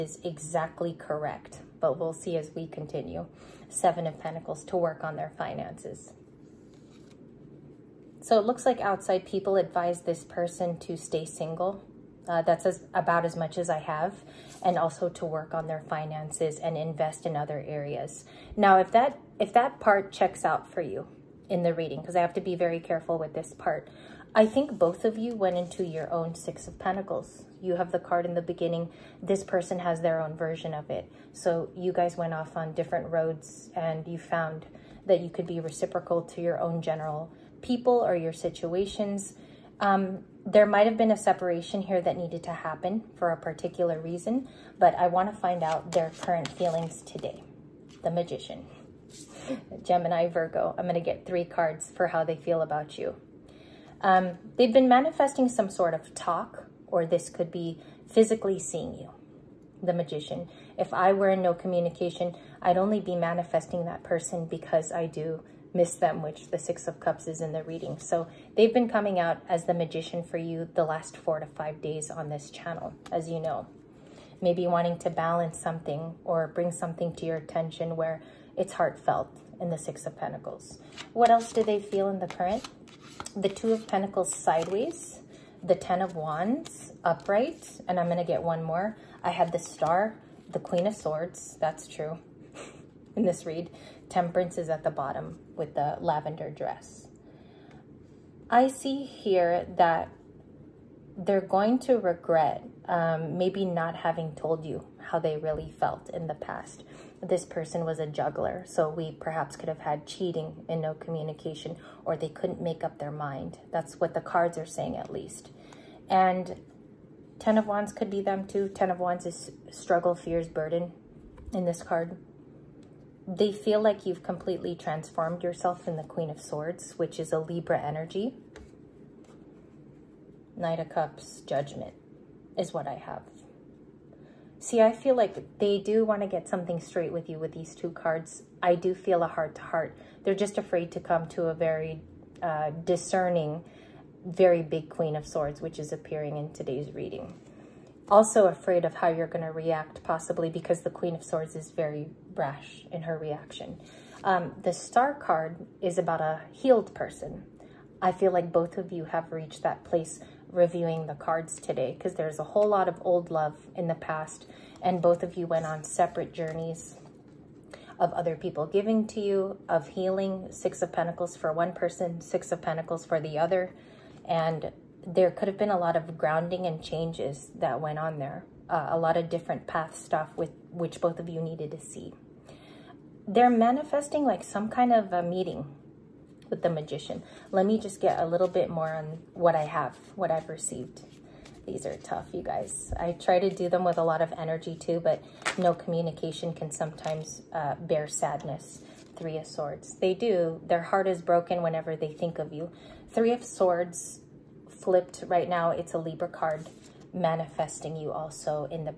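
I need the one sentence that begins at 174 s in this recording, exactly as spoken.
And there could have been a lot of grounding and changes that went on there.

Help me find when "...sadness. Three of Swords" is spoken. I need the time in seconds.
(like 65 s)
198 s.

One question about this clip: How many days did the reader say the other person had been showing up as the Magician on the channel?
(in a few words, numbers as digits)
4 to 5.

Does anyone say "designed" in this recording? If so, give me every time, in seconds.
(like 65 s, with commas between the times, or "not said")
not said.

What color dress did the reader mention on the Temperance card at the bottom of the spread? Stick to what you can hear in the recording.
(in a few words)
Lavender.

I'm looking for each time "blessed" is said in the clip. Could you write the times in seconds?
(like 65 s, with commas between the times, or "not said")
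not said.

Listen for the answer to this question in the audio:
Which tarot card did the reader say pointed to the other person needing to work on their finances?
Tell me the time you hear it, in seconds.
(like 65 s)
3 s.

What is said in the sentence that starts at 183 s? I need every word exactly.
They're manifesting like some kind of a meeting with the magician.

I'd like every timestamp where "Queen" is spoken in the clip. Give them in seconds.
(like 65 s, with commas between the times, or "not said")
90 s, 126 s, 144 s, 150 s.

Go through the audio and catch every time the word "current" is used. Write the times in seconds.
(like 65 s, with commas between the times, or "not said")
46 s, 82 s.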